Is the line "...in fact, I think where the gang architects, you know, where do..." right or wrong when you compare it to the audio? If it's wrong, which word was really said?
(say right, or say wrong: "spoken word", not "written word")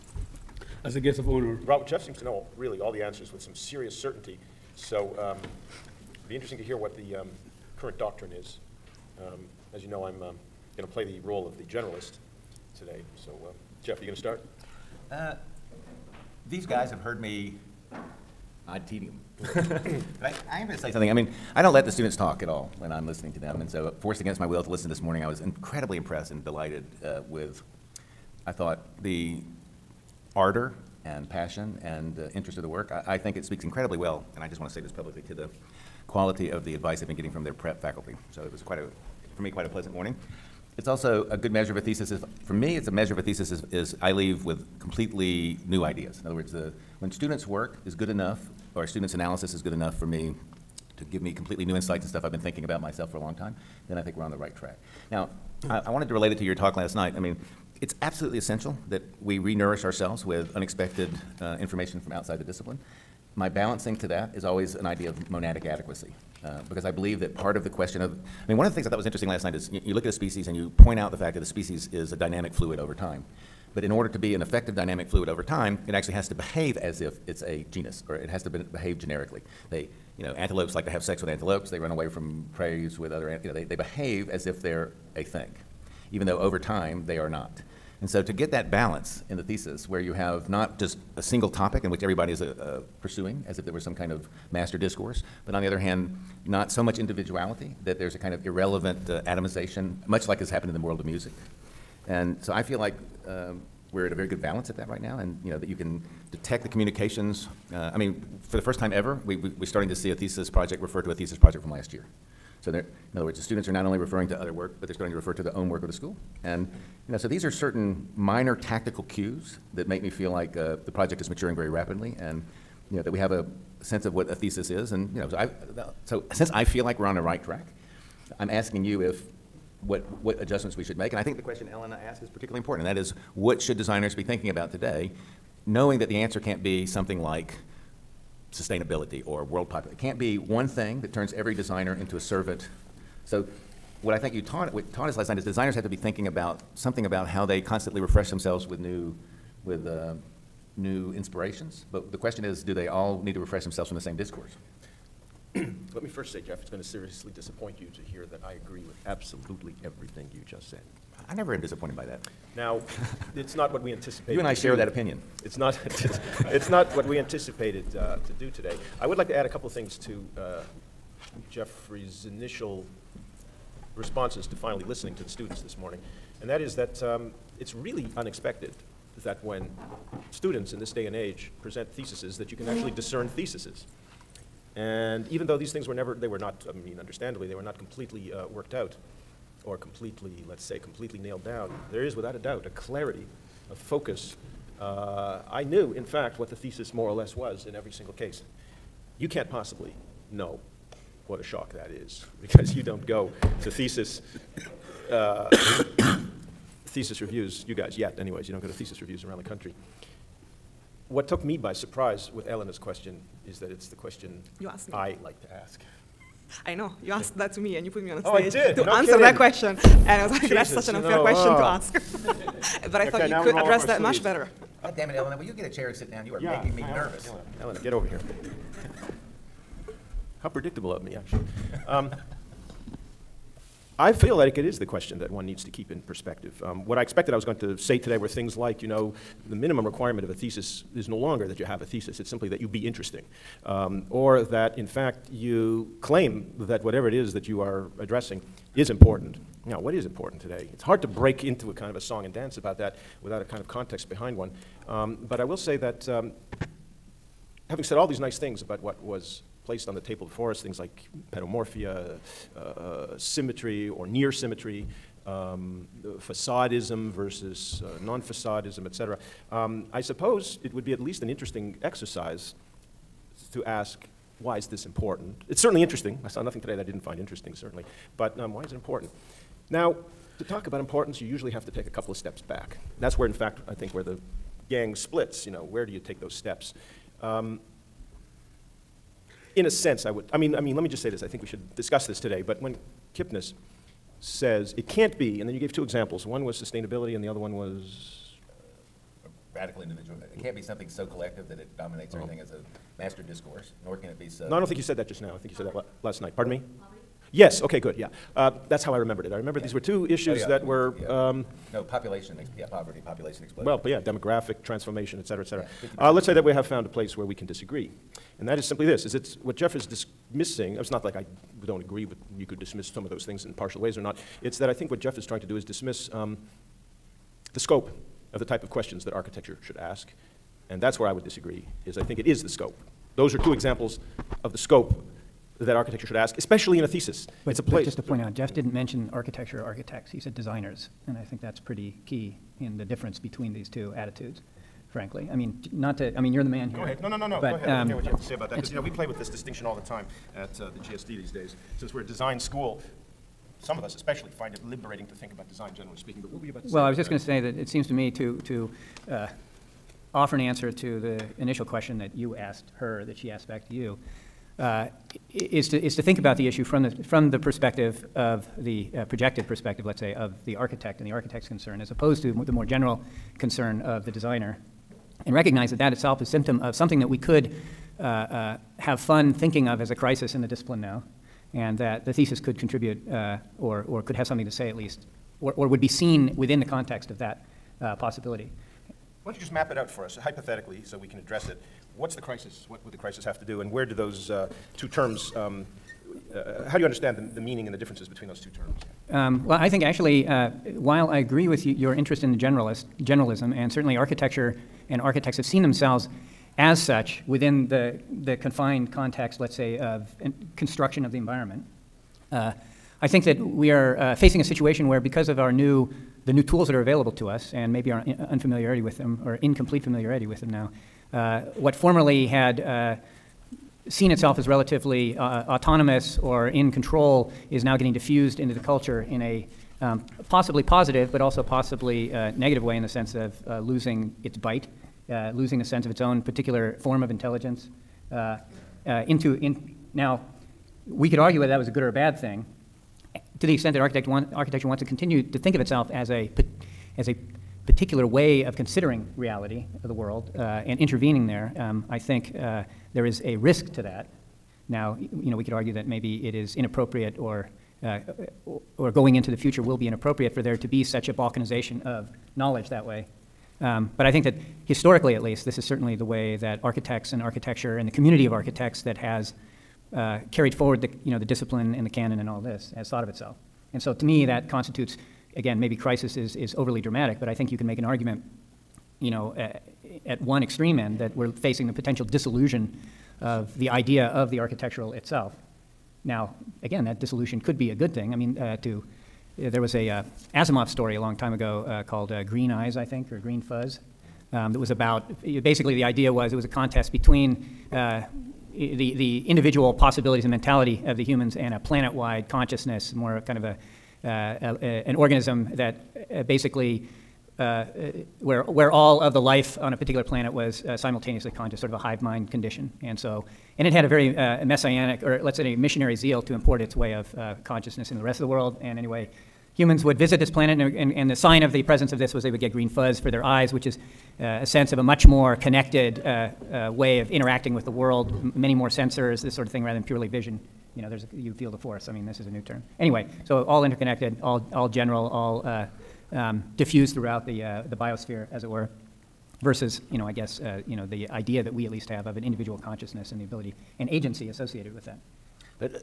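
wrong: "splits", not "architects".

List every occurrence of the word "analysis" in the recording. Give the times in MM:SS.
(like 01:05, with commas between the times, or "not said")
00:49.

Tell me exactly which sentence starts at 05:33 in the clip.
Those are two examples of the scope that architecture should ask, especially in a thesis.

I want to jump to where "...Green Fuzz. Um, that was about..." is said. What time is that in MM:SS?
08:13.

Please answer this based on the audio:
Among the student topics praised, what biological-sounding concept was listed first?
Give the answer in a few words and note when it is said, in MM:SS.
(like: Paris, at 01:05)
pedomorphia, at 04:21.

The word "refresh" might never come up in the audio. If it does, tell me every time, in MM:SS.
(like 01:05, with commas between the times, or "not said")
02:27, 02:33.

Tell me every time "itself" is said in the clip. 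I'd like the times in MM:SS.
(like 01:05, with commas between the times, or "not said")
06:15, 07:04, 07:25, 07:53, 08:04.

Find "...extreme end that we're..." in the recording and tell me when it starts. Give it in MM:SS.
08:00.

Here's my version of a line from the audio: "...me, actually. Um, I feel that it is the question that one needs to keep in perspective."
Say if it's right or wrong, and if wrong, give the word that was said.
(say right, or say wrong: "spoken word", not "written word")
right.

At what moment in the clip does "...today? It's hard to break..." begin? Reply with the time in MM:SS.
04:10.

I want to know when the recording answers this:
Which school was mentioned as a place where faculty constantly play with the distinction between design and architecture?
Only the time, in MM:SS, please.
05:50.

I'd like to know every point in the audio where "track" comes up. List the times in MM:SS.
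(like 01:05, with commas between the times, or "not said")
00:54, 02:07.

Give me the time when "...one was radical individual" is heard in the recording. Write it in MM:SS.
04:57.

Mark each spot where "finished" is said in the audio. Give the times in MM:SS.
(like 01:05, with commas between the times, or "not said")
not said.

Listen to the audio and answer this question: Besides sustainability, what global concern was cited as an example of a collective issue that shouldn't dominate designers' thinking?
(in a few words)
world population.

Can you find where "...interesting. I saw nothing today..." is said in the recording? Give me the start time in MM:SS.
04:35.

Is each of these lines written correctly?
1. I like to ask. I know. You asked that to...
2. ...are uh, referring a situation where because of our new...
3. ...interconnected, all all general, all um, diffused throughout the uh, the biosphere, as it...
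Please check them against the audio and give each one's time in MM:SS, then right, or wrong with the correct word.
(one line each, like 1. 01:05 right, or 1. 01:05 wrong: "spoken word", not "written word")
1. 03:34 right
2. 06:53 wrong: "facing", not "referring"
3. 08:53 right.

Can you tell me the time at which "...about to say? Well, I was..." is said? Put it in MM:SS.
05:56.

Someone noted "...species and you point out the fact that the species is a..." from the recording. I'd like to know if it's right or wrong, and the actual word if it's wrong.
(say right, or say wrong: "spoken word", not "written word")
right.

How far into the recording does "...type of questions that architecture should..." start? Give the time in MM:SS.
05:28.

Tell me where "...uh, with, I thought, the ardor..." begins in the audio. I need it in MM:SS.
00:27.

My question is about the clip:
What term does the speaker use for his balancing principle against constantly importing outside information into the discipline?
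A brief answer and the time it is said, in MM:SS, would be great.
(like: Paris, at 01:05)
monadic adequacy, at 01:05.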